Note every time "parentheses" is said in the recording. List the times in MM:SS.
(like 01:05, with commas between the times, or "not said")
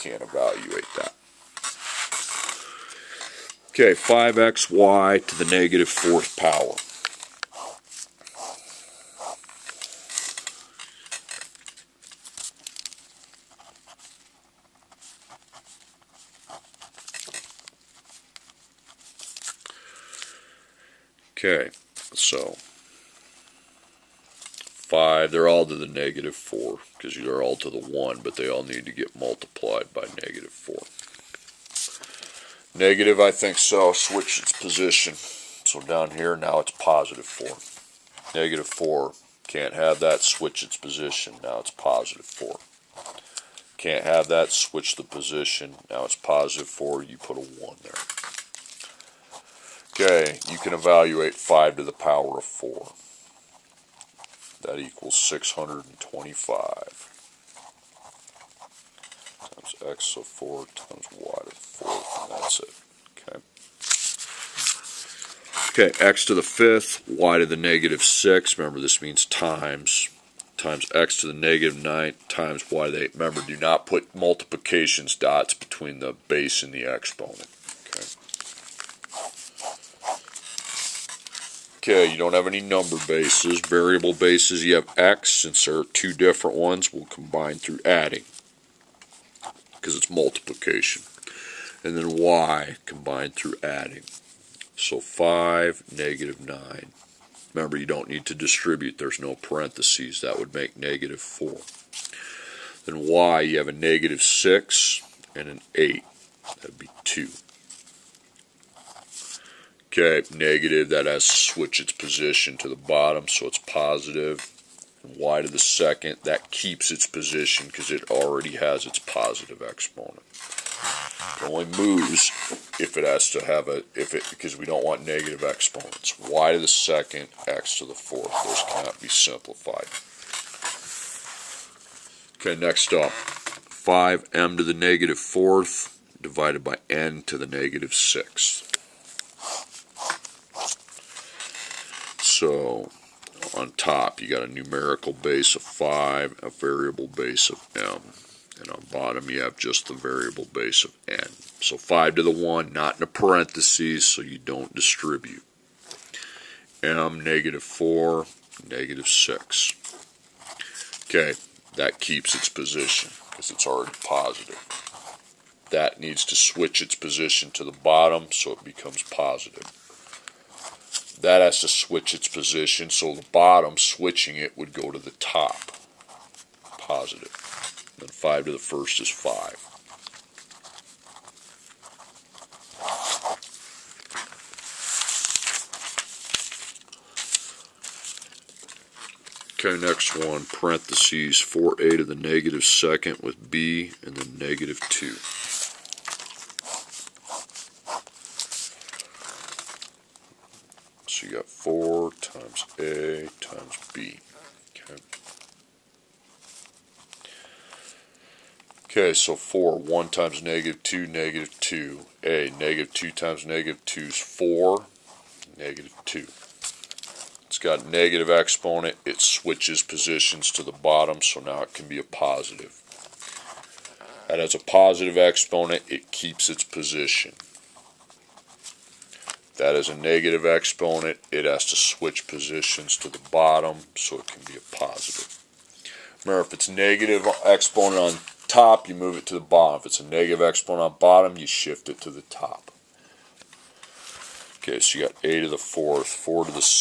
01:39, 02:33, 03:10.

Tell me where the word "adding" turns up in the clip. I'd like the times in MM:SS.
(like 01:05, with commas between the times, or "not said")
01:27, 01:33.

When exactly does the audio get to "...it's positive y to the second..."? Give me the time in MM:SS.
01:53.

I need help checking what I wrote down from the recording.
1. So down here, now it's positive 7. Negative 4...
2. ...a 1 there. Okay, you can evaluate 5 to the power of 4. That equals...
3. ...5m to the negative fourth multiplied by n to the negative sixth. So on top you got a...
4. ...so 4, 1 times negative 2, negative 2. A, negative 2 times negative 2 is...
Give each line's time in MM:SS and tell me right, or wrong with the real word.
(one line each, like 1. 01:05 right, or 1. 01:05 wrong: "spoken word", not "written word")
1. 00:35 wrong: "4", not "7"
2. 00:47 right
3. 02:13 wrong: "divided", not "multiplied"
4. 03:29 right.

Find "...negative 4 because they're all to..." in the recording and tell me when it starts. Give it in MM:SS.
00:25.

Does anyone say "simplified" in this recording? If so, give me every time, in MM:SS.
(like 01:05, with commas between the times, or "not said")
02:09.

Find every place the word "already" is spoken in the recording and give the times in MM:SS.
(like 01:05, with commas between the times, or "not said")
01:58, 02:43.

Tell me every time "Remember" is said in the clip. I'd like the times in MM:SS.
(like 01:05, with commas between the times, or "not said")
01:08, 01:13, 01:37, 03:56.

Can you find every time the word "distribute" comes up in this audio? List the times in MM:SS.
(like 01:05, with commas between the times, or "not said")
01:38, 02:34.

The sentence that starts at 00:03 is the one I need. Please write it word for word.
Okay, 5xy to the negative fourth power.